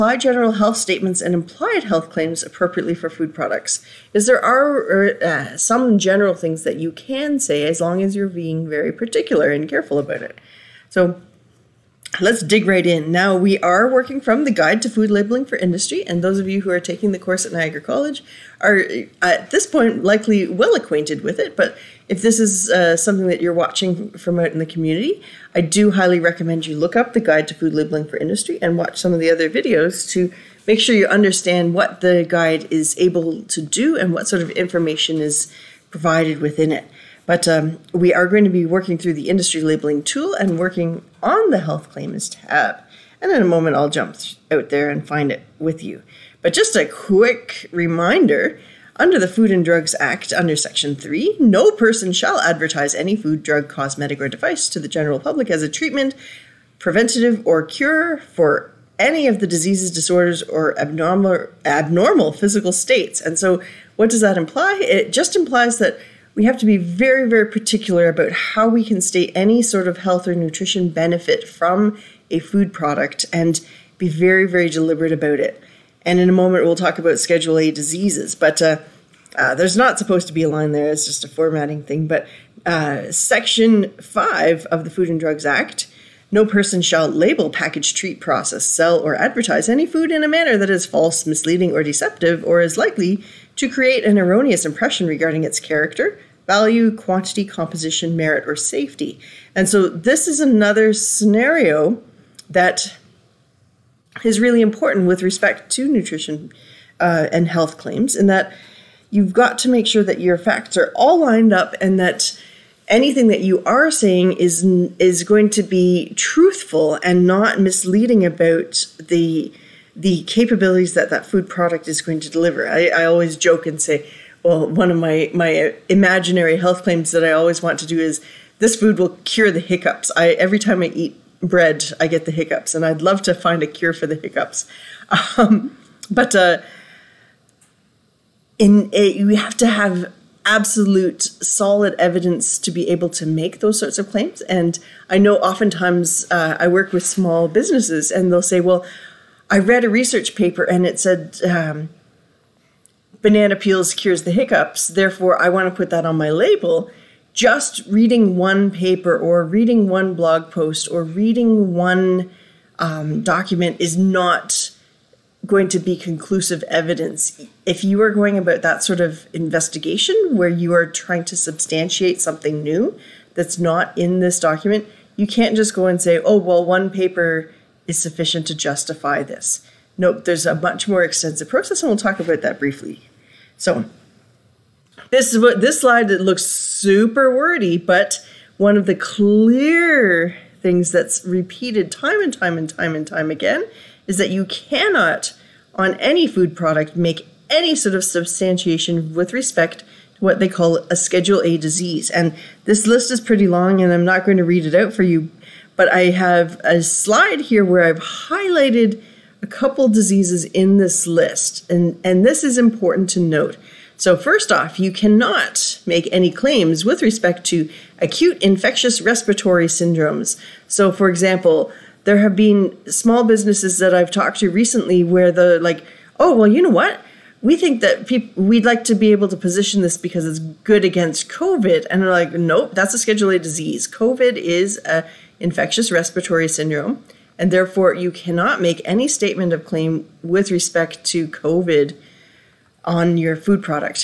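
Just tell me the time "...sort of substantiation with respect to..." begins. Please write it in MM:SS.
03:17.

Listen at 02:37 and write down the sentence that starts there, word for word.
Just reading one paper or reading one blog post or reading one um, document is not going to be conclusive evidence.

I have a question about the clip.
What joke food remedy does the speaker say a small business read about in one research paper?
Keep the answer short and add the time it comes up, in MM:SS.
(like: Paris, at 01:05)
banana peels, at 02:33.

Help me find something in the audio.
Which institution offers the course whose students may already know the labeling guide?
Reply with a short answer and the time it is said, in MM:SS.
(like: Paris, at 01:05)
Niagara College, at 00:17.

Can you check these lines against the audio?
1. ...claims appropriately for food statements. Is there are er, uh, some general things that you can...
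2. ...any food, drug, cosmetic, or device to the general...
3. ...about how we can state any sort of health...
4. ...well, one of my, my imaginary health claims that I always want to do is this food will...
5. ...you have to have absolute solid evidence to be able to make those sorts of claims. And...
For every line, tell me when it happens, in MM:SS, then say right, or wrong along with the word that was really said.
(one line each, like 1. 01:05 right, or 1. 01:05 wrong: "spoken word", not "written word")
1. 00:02 wrong: "products", not "statements"
2. 00:52 right
3. 01:08 right
4. 02:04 right
5. 02:19 right.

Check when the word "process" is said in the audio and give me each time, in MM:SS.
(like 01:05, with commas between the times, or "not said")
01:28, 03:01.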